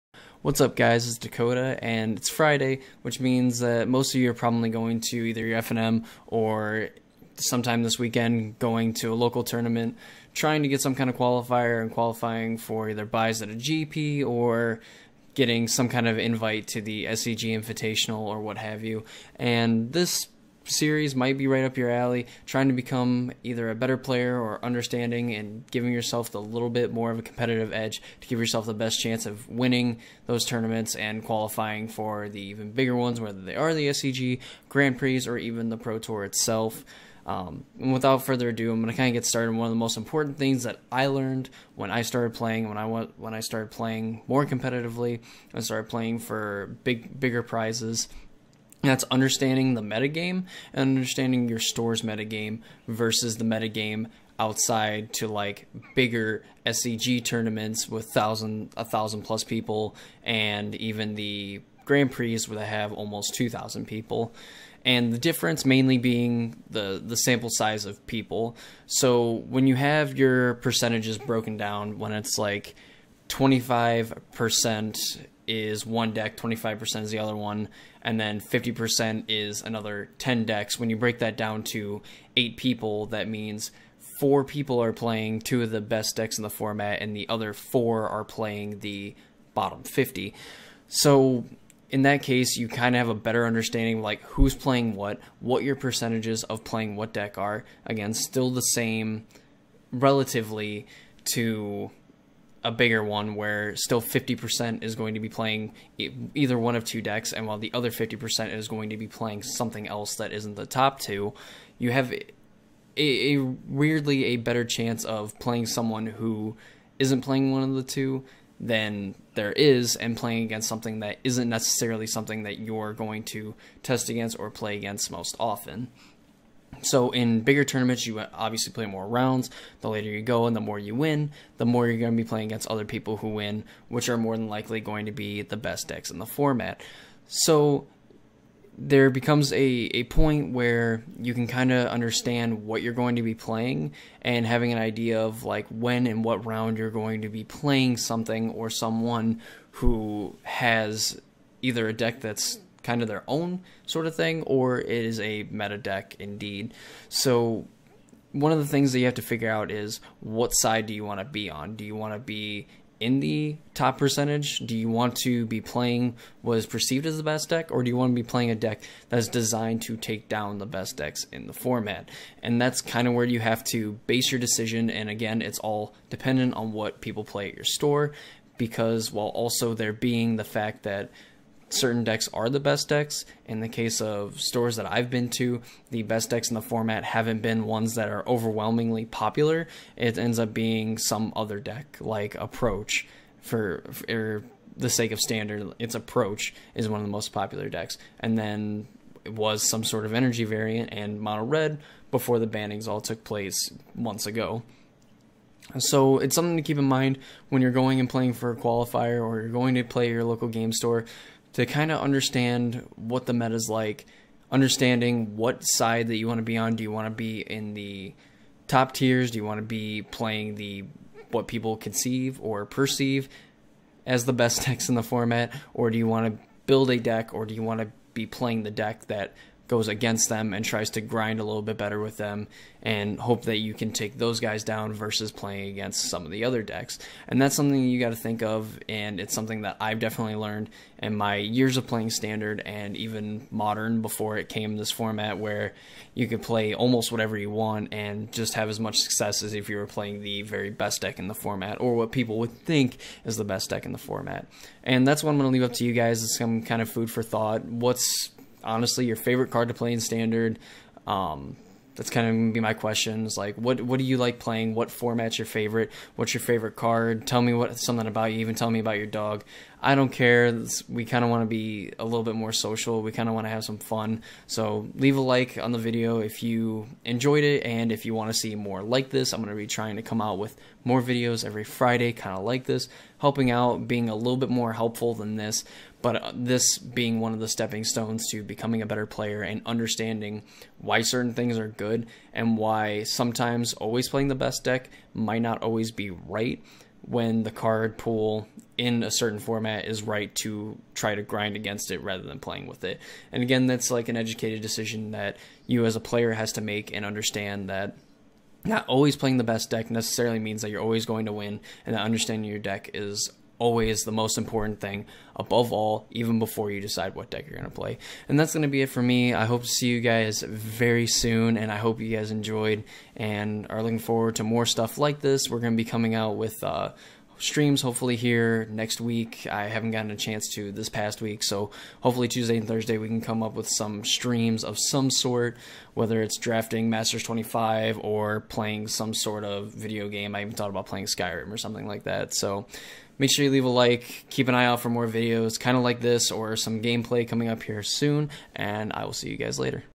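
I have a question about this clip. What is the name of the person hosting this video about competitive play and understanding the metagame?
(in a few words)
Dakota.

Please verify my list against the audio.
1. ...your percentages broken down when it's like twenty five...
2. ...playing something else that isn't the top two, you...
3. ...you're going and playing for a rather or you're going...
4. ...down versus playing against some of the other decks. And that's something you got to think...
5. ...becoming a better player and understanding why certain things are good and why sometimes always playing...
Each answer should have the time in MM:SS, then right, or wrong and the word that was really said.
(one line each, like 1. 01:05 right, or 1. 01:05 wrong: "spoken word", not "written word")
1. 01:10 right
2. 01:49 right
3. 03:27 wrong: "qualifier", not "rather"
4. 03:54 right
5. 04:48 right.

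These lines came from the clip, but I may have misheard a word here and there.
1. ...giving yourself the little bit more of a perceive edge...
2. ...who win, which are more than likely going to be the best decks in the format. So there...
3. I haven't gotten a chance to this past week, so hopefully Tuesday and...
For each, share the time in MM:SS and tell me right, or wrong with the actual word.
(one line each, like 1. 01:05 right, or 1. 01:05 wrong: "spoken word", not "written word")
1. 00:25 wrong: "competitive", not "perceive"
2. 02:13 right
3. 05:29 right.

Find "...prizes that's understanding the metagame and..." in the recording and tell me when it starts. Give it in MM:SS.
00:47.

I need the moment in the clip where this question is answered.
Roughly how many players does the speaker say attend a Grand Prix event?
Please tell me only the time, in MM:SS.
01:02.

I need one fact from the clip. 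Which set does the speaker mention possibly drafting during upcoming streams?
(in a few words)
Masters 25.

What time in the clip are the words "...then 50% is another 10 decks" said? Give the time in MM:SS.
01:18.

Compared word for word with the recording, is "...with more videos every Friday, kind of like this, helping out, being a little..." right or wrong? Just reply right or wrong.
right.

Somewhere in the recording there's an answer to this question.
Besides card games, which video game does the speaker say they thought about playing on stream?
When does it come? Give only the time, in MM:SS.
05:41.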